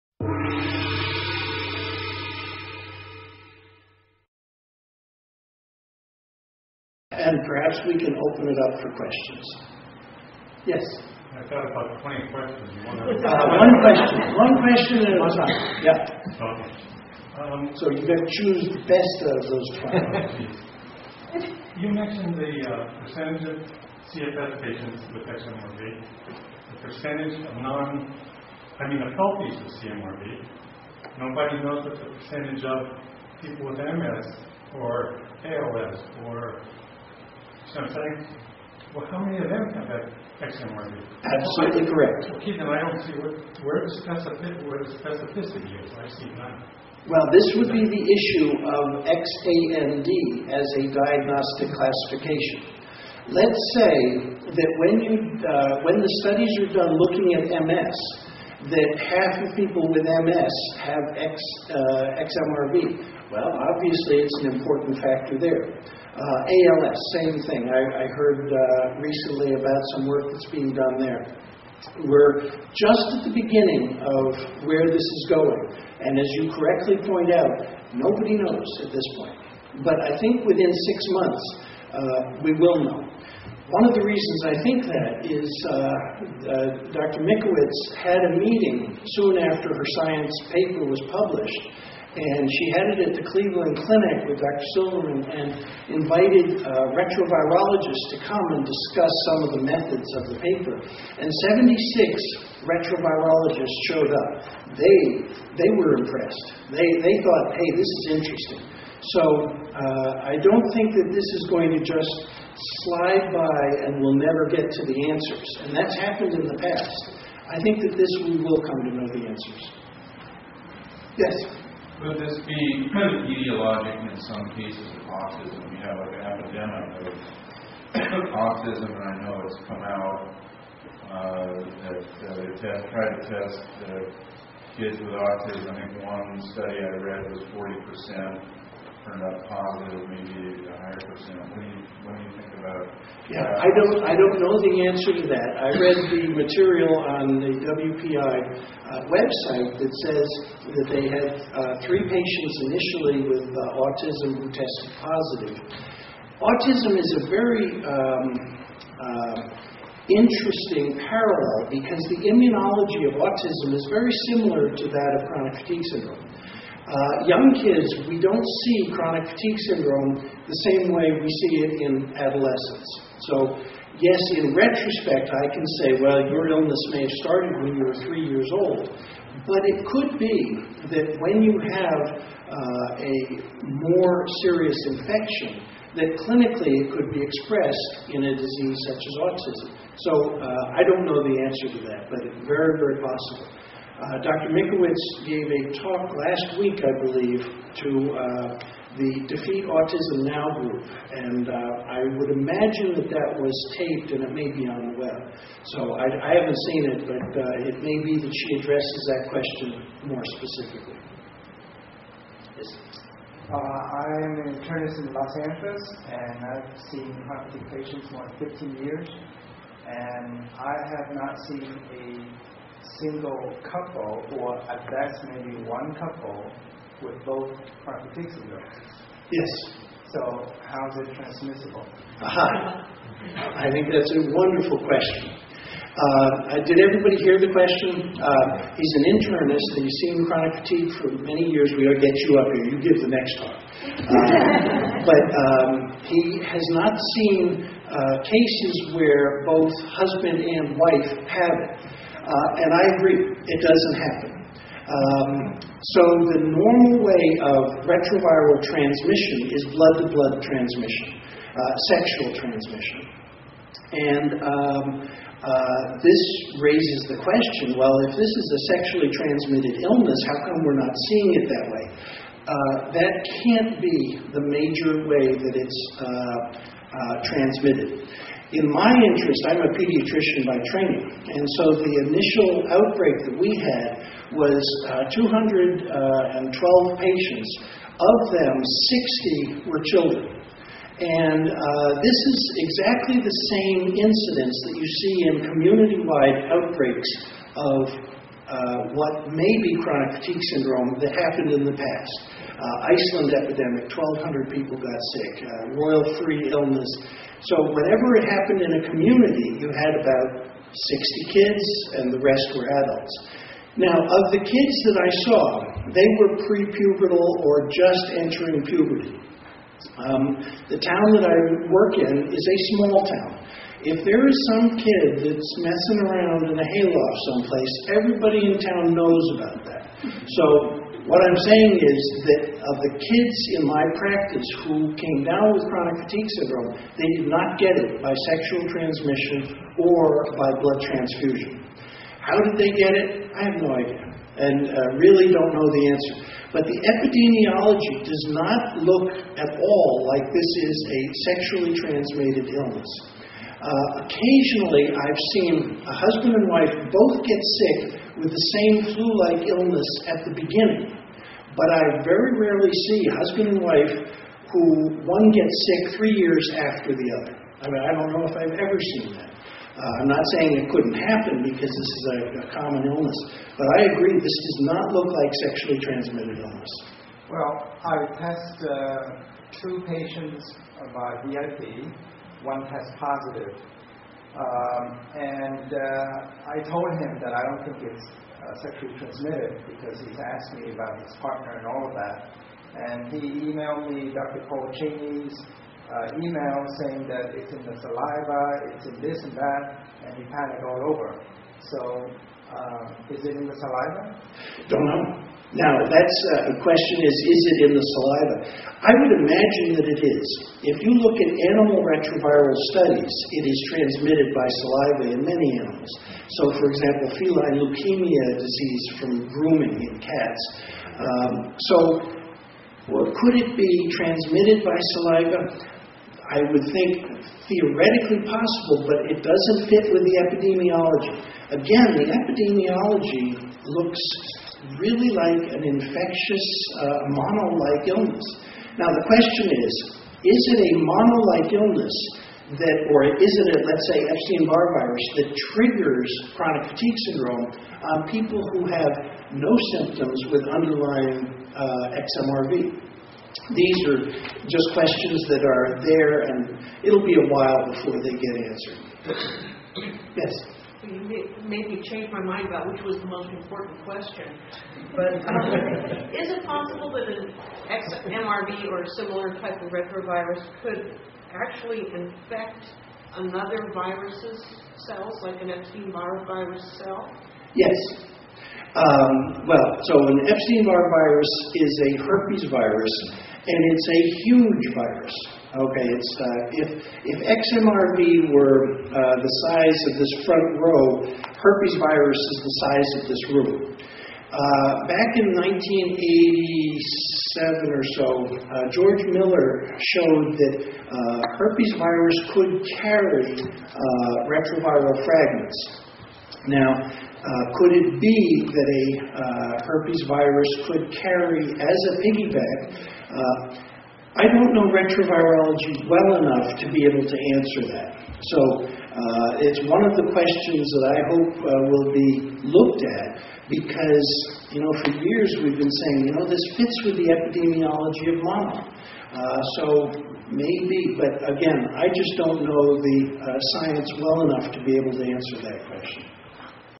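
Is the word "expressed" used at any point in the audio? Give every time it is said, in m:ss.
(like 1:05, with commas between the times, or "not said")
3:07.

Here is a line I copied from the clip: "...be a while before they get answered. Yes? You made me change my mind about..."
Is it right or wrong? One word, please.
right.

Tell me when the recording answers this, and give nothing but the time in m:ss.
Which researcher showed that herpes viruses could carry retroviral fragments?
8:18.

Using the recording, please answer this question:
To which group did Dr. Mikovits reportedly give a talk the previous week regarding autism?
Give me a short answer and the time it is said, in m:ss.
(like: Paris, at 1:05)
Defeat Autism Now, at 3:19.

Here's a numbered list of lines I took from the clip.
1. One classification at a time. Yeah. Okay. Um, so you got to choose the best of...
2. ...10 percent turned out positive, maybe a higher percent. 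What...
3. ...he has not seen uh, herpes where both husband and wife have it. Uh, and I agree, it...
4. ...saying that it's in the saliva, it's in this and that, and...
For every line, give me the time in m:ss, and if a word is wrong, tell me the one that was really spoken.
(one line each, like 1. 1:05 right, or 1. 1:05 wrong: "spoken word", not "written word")
1. 0:14 wrong: "question", not "classification"
2. 2:17 wrong: "40", not "10"
3. 4:06 wrong: "cases", not "herpes"
4. 6:36 right.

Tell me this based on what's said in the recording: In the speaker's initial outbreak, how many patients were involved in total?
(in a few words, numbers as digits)
212.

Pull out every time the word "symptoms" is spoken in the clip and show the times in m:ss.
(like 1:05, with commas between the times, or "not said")
7:29.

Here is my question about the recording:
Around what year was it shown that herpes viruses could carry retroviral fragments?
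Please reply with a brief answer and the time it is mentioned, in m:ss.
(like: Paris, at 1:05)
1987, at 8:15.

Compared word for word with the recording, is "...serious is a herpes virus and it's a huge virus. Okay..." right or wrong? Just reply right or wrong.
wrong.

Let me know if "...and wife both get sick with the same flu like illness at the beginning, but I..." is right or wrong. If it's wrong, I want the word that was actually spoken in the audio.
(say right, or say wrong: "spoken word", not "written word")
right.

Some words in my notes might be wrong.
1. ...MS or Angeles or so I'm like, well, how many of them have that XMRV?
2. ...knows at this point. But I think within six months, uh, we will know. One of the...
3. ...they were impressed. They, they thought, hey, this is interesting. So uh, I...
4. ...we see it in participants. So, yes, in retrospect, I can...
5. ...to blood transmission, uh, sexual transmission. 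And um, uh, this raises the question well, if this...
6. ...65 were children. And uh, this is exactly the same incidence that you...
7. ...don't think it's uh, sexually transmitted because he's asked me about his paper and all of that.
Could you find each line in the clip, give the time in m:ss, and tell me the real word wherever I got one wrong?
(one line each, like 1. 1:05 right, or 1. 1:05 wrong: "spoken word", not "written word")
1. 0:33 wrong: "ALS", not "Angeles"
2. 1:18 right
3. 1:45 right
4. 2:51 wrong: "adolescents", not "participants"
5. 4:20 right
6. 4:49 wrong: "60", not "65"
7. 6:27 wrong: "partner", not "paper".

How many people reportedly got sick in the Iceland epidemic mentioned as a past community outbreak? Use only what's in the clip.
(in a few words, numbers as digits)
1,200.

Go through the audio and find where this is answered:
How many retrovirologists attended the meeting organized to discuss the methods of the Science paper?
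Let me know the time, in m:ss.
1:41.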